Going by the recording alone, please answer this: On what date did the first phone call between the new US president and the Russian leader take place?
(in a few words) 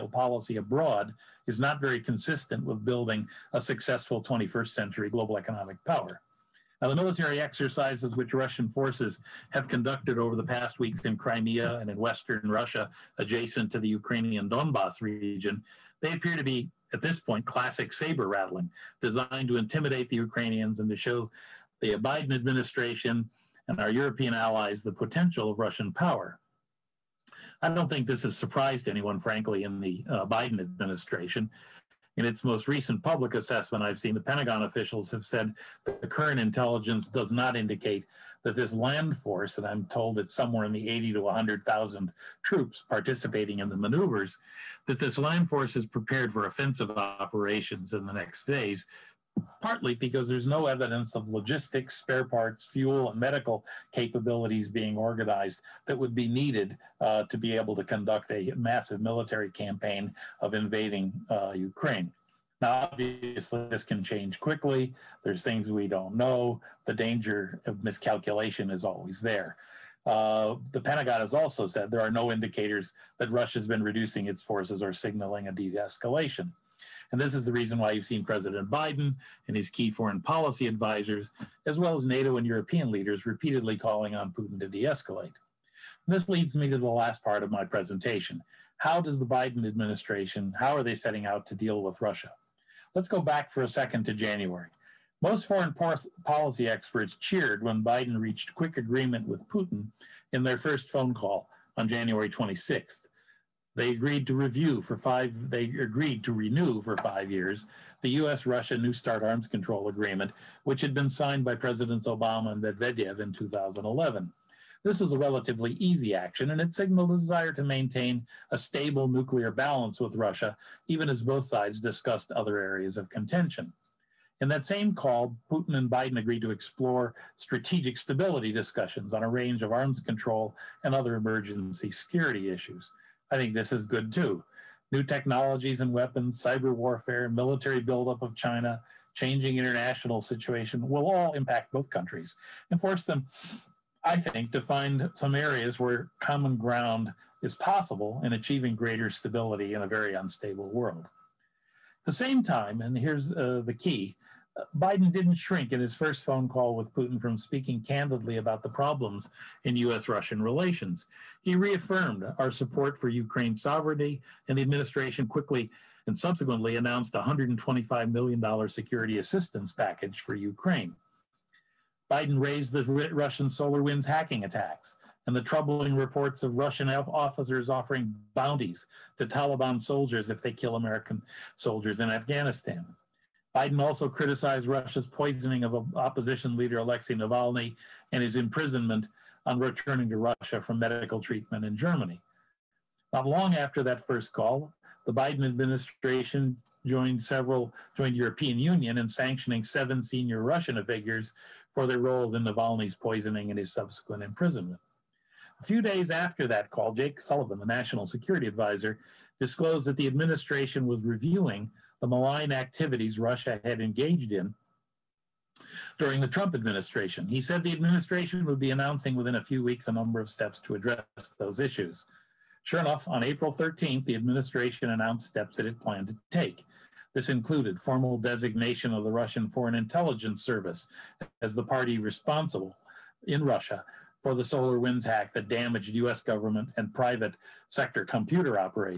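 January 26th.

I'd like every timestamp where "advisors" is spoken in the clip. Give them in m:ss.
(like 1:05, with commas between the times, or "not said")
1:20, 3:28.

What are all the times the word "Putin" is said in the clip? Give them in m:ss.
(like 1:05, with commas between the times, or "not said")
1:24, 1:39, 2:05, 2:36.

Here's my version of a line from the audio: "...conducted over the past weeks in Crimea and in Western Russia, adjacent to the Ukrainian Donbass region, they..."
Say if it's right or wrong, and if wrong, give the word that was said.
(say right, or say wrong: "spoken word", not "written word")
right.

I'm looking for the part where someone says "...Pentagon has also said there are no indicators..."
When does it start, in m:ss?
1:10.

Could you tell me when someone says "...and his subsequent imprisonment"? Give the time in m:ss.
3:23.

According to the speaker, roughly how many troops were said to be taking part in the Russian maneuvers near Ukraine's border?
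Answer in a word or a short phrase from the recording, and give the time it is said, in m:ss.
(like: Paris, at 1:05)
80 to 100,000, at 0:40.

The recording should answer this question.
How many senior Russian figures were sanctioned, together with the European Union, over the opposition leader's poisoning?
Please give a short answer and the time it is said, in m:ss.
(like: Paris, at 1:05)
7, at 3:19.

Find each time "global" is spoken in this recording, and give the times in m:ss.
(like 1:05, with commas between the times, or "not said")
0:05.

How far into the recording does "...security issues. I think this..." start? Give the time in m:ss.
2:11.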